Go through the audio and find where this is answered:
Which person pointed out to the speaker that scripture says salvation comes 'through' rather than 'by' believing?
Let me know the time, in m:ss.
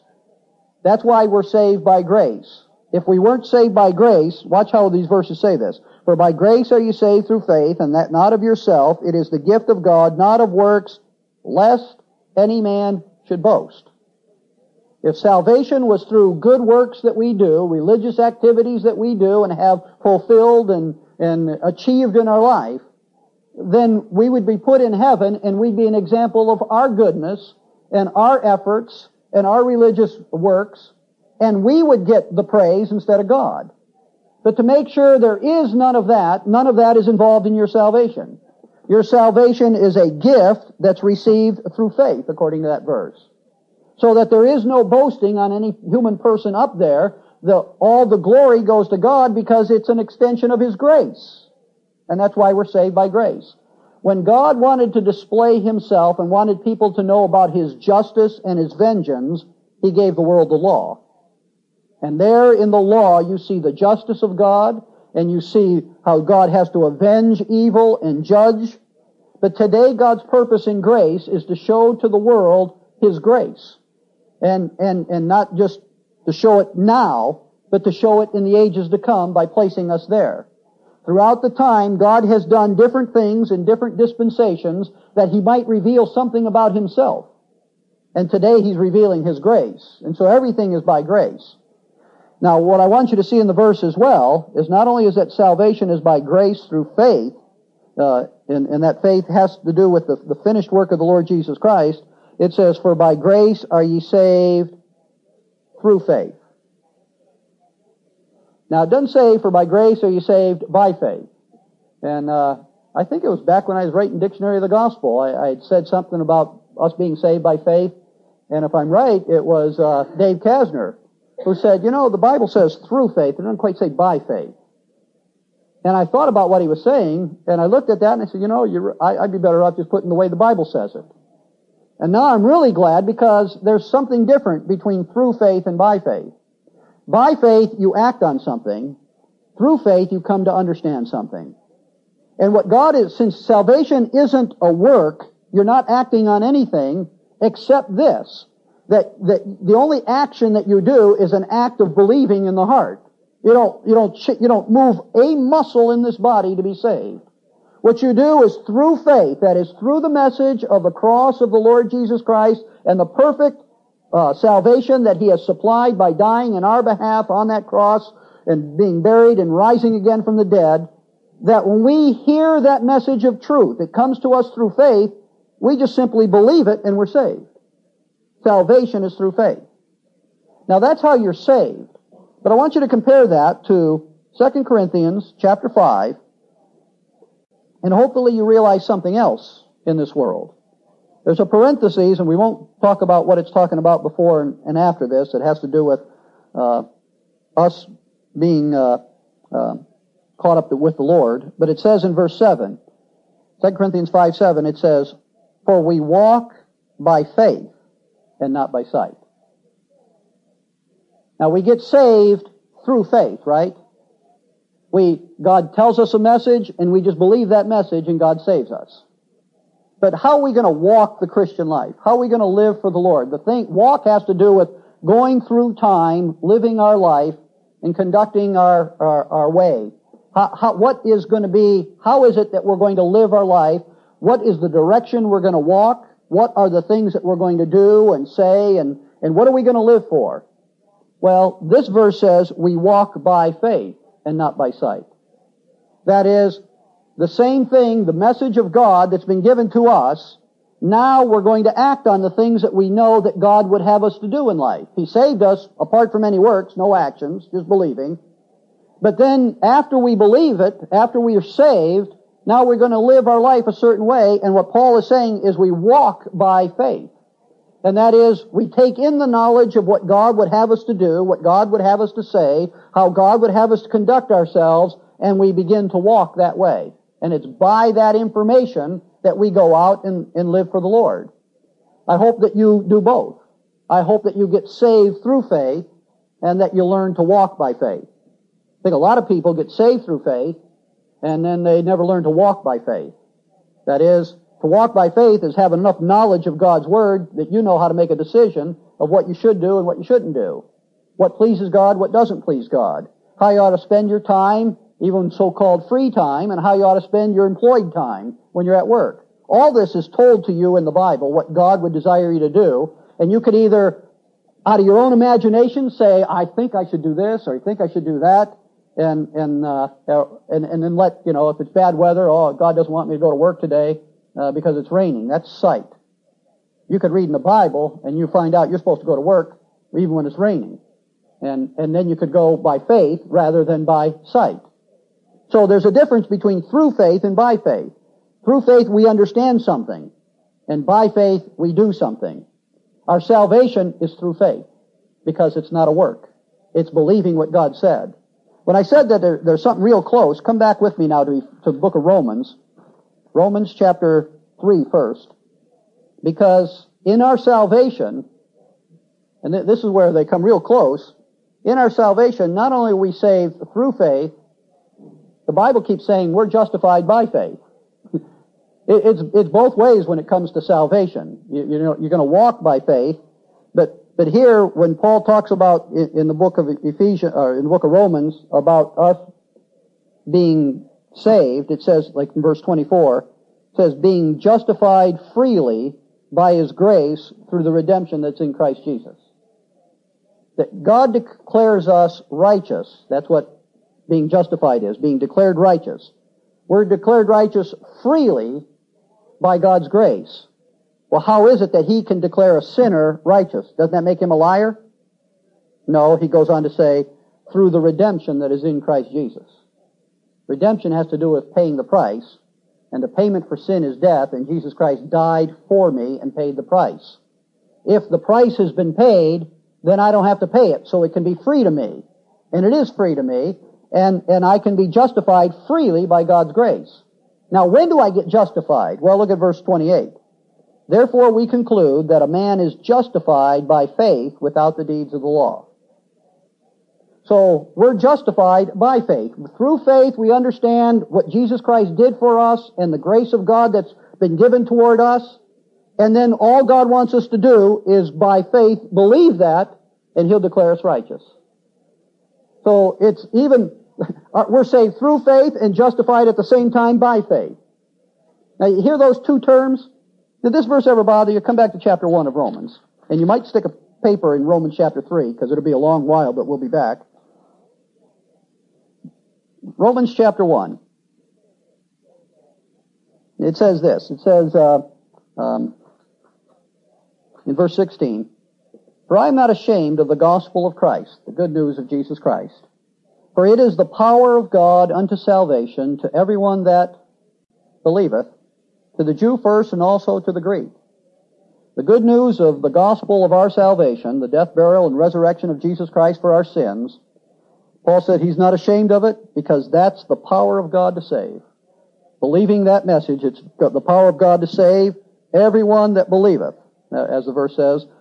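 2:00.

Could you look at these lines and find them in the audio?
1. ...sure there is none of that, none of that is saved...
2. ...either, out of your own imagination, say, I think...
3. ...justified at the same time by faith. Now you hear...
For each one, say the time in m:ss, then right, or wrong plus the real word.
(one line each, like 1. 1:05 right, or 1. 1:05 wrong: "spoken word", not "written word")
1. 0:34 wrong: "involved", not "saved"
2. 5:13 right
3. 7:35 right.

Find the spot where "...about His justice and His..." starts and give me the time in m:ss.
0:57.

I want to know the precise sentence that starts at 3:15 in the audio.
It has to do with uh, us being uh, uh, caught up with the Lord.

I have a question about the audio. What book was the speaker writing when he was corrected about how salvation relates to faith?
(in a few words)
Dictionary of the Gospel.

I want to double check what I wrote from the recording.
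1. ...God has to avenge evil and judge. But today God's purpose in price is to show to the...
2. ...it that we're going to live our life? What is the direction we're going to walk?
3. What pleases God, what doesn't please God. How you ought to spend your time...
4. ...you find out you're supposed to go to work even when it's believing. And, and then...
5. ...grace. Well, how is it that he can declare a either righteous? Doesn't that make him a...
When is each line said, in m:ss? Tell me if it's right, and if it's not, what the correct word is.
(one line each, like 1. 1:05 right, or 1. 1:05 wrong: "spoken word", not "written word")
1. 1:06 wrong: "grace", not "price"
2. 3:52 right
3. 5:01 right
4. 5:28 wrong: "raining", not "believing"
5. 6:39 wrong: "sinner", not "either".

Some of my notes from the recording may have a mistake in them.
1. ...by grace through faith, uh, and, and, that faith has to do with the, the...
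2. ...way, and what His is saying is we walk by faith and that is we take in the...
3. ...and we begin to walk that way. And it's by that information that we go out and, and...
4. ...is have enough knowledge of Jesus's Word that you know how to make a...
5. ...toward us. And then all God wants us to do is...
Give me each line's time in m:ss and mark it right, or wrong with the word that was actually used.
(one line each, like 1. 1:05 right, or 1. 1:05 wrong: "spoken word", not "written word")
1. 1:36 right
2. 4:24 wrong: "Paul", not "His"
3. 4:35 right
4. 4:55 wrong: "God", not "Jesus"
5. 7:24 right.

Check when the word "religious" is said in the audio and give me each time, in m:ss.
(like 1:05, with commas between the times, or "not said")
0:17, 0:29.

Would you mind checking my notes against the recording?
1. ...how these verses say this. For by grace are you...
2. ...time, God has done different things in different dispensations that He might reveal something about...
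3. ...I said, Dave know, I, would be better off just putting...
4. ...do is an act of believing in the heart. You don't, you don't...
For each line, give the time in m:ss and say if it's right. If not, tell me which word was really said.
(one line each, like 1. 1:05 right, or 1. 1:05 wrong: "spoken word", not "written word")
1. 0:04 right
2. 1:21 right
3. 2:08 wrong: "You", not "Dave"
4. 2:30 right.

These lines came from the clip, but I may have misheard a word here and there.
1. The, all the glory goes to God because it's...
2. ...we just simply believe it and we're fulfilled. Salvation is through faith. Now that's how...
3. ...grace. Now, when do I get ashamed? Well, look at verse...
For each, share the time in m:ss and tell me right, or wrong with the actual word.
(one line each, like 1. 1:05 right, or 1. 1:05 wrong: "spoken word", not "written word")
1. 0:47 right
2. 2:55 wrong: "saved", not "fulfilled"
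3. 7:06 wrong: "justified", not "ashamed".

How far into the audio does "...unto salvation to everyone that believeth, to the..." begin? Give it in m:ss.
8:04.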